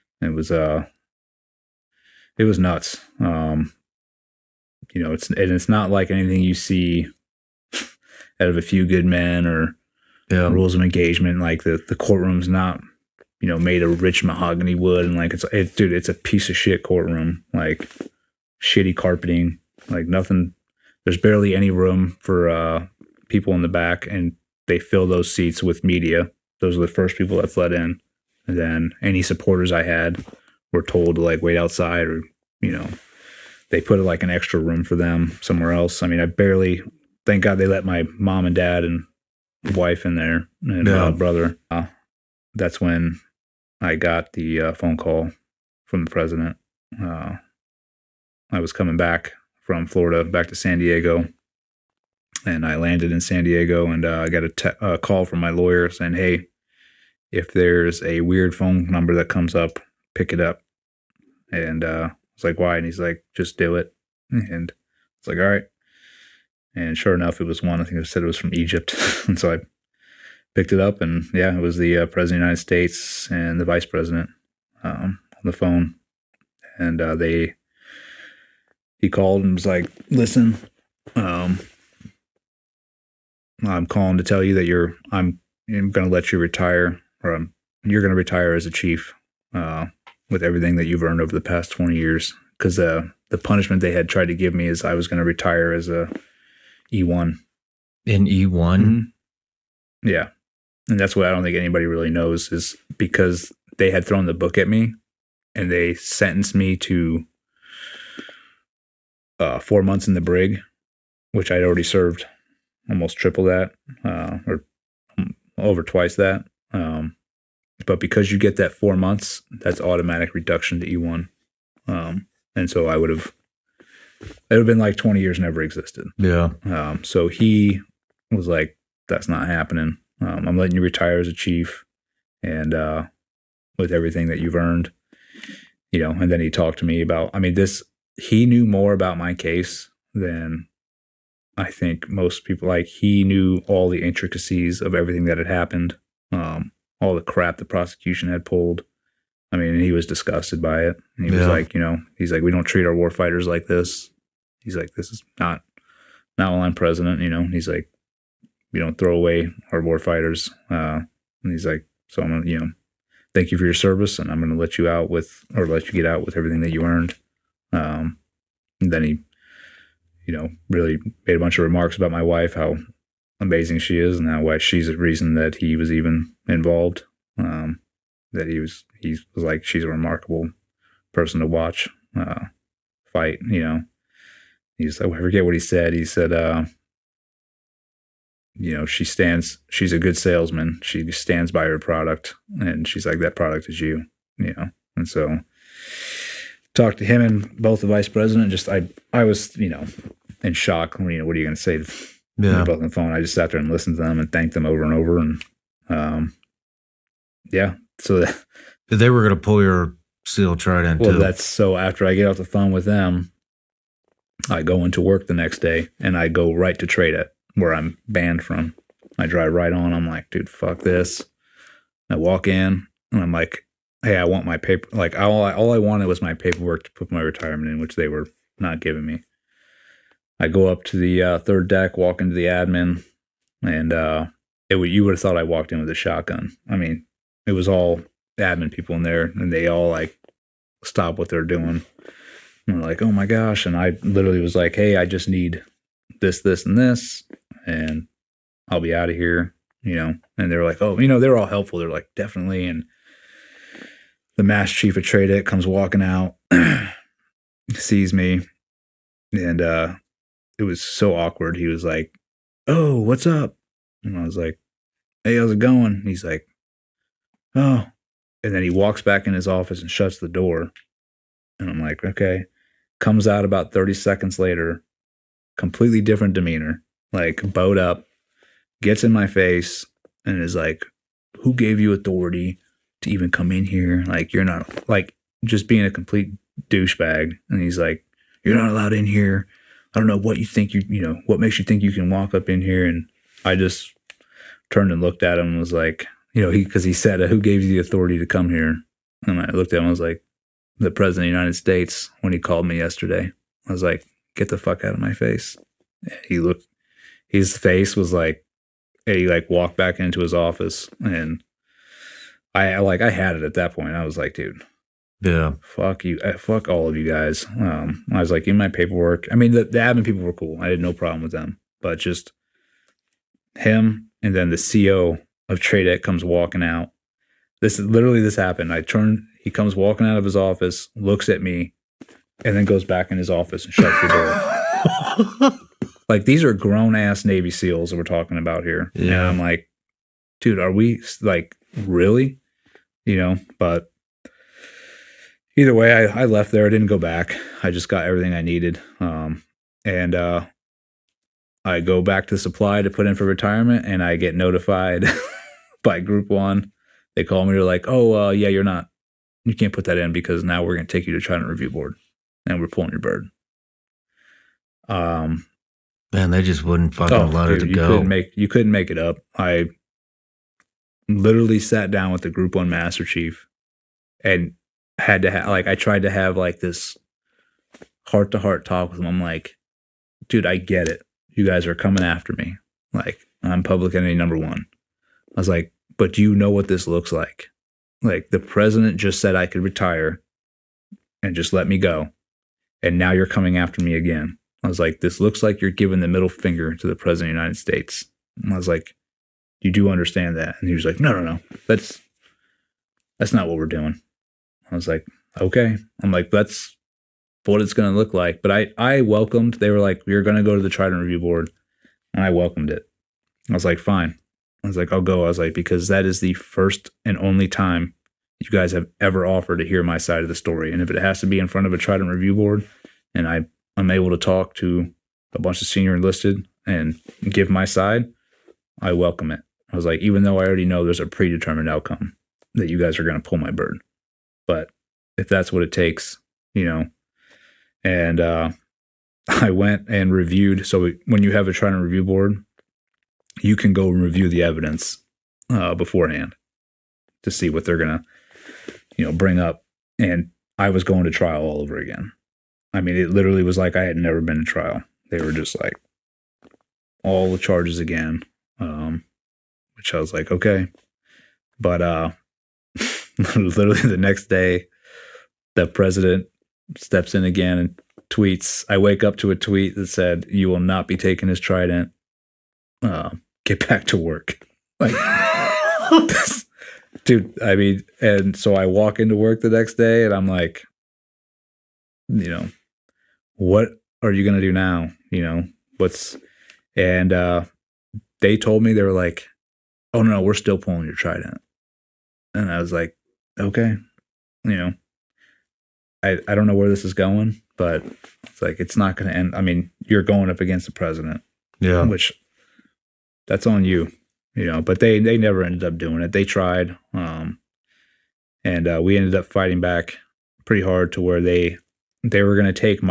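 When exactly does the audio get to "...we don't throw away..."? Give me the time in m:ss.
2:38.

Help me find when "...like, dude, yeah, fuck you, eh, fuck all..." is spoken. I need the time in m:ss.
5:14.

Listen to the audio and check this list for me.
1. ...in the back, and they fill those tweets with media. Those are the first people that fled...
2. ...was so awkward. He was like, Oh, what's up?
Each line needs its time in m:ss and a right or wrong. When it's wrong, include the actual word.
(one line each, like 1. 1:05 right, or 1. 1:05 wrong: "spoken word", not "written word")
1. 0:23 wrong: "seats", not "tweets"
2. 4:20 right.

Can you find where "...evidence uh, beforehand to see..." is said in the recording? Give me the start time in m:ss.
7:24.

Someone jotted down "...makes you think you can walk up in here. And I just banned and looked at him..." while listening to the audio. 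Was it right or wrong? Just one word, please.
wrong.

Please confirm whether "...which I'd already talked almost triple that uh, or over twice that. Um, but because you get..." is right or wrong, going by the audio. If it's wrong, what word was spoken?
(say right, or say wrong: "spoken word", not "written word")
wrong: "served", not "talked".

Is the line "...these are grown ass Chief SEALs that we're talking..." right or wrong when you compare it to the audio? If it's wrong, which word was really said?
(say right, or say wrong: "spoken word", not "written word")
wrong: "Navy", not "Chief".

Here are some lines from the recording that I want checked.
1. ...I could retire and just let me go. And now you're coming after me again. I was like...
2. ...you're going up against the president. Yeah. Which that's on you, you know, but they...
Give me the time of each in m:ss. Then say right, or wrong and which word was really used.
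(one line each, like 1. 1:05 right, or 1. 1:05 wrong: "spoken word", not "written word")
1. 6:29 right
2. 8:19 right.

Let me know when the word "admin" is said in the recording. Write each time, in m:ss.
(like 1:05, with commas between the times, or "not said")
3:52, 3:58, 5:19.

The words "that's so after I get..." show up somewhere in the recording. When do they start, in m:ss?
3:31.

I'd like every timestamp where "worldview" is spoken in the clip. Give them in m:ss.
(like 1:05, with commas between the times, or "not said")
not said.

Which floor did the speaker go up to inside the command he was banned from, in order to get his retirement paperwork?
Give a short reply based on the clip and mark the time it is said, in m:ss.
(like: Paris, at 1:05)
Third deck, at 3:51.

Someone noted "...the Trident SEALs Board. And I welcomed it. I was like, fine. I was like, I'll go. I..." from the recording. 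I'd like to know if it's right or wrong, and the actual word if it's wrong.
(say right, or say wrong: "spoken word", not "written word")
wrong: "Review", not "SEALs".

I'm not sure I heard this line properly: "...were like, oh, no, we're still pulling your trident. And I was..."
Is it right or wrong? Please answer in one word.
right.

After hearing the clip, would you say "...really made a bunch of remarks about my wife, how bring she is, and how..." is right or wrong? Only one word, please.
wrong.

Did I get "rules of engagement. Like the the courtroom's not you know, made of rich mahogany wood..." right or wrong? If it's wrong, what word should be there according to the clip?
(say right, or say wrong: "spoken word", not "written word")
right.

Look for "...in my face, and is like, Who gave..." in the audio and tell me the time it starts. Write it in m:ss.
4:39.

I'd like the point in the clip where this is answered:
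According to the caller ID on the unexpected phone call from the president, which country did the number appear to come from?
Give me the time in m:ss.
1:08.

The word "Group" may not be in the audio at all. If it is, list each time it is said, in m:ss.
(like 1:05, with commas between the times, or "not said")
5:55, 6:12.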